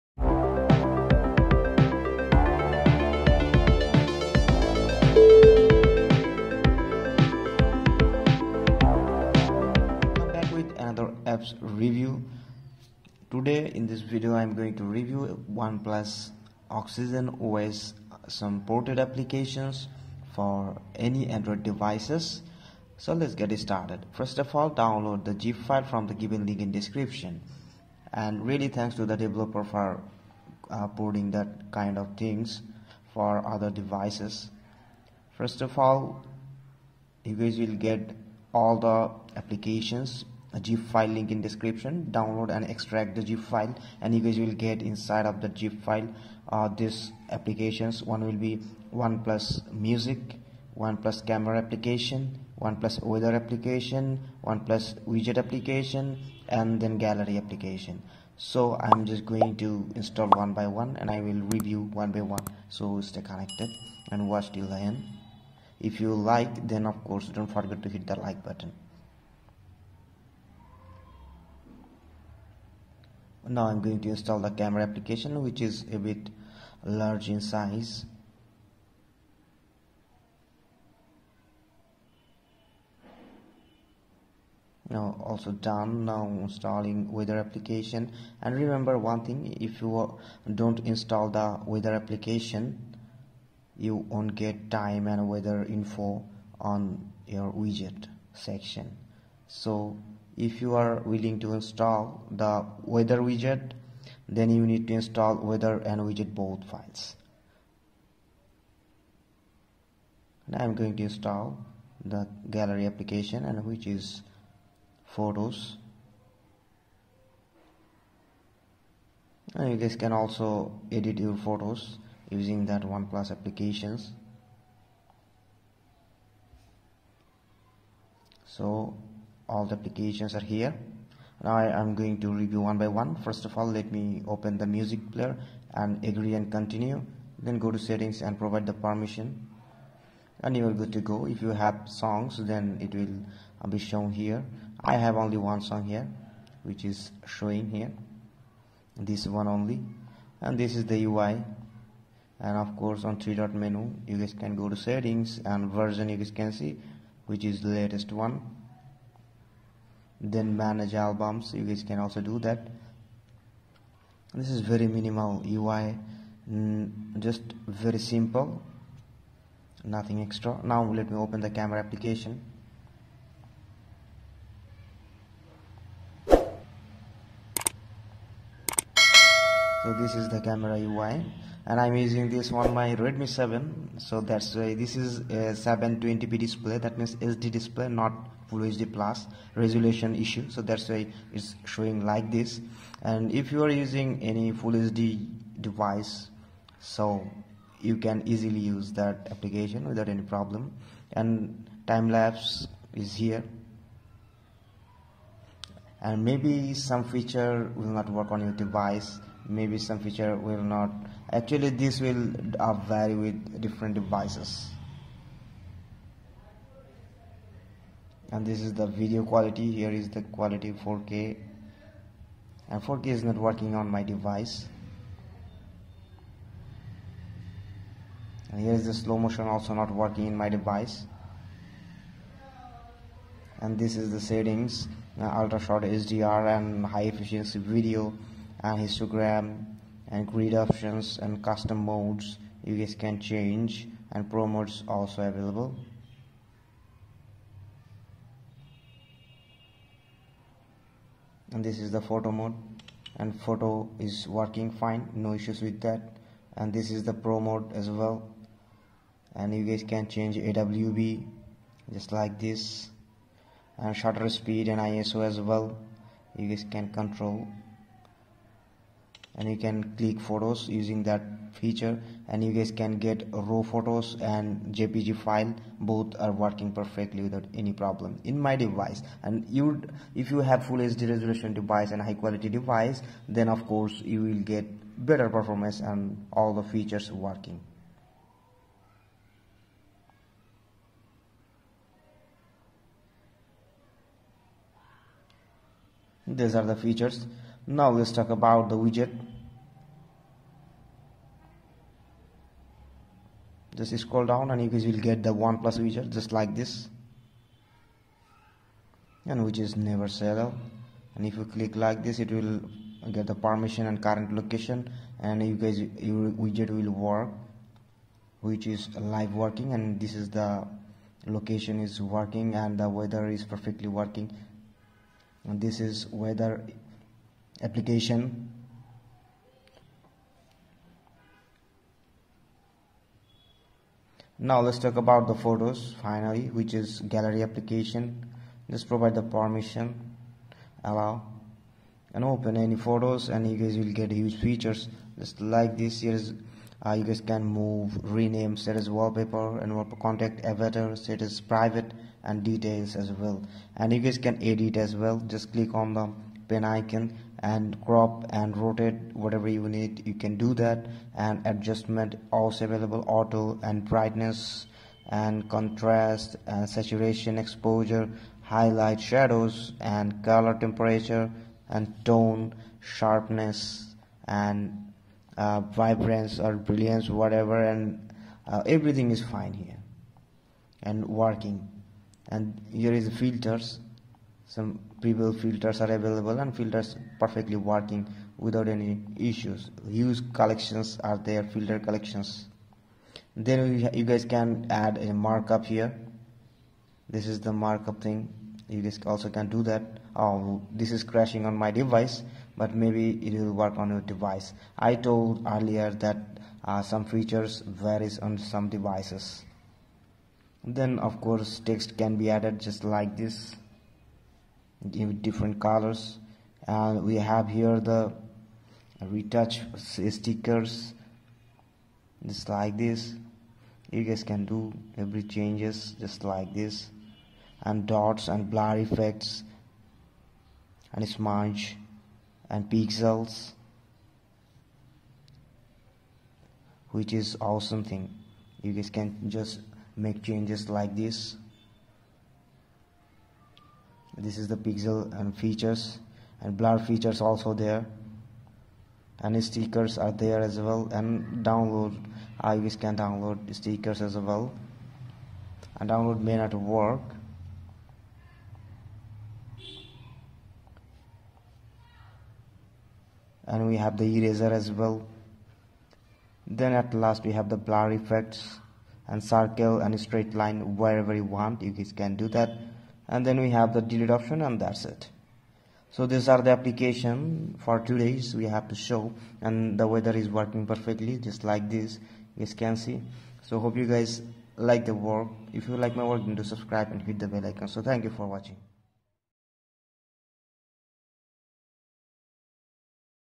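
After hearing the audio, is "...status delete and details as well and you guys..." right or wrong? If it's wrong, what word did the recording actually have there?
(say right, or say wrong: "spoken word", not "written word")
wrong: "private", not "delete".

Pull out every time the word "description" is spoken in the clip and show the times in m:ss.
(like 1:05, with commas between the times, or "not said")
0:26, 0:41.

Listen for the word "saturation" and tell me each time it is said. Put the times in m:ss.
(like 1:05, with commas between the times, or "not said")
6:06.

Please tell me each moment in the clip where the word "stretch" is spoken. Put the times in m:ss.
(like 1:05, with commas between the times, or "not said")
not said.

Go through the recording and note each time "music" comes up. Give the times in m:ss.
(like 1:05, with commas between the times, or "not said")
0:49, 2:14.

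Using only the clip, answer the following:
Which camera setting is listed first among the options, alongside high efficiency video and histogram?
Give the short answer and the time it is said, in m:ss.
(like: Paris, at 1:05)
Ultrashot HDR, at 3:55.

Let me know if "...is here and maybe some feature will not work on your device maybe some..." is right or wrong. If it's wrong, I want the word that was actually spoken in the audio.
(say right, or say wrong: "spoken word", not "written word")
right.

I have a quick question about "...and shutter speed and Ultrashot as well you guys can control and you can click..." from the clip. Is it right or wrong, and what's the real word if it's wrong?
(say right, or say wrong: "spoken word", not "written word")
wrong: "ISO", not "Ultrashot".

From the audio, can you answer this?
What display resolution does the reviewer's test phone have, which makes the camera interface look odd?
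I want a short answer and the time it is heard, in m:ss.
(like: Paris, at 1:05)
720p, at 3:05.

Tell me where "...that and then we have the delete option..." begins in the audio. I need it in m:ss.
7:52.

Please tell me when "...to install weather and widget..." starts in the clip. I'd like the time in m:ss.
1:44.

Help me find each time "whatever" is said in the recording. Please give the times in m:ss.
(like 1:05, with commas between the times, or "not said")
5:59, 6:17.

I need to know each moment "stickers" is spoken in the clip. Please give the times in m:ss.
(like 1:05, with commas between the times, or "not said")
6:59, 7:29, 7:33.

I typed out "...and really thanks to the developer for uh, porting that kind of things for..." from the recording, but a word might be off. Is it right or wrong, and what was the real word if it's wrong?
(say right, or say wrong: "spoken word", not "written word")
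right.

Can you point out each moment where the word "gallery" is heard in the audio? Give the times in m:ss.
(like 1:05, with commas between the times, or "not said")
0:56, 1:52, 5:37.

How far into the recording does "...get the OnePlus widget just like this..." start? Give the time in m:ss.
5:04.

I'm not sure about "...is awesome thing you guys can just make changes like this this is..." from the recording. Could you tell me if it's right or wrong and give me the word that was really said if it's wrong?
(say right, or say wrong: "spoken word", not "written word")
right.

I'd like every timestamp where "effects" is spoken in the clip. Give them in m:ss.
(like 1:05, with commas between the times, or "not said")
7:08, 7:47.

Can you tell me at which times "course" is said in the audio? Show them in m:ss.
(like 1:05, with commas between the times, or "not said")
1:07, 2:32, 4:43, 6:51.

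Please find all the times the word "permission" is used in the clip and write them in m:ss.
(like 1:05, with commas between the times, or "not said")
2:18, 5:13, 5:39.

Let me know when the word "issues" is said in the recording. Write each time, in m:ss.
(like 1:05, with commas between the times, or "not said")
3:10, 4:15, 6:29.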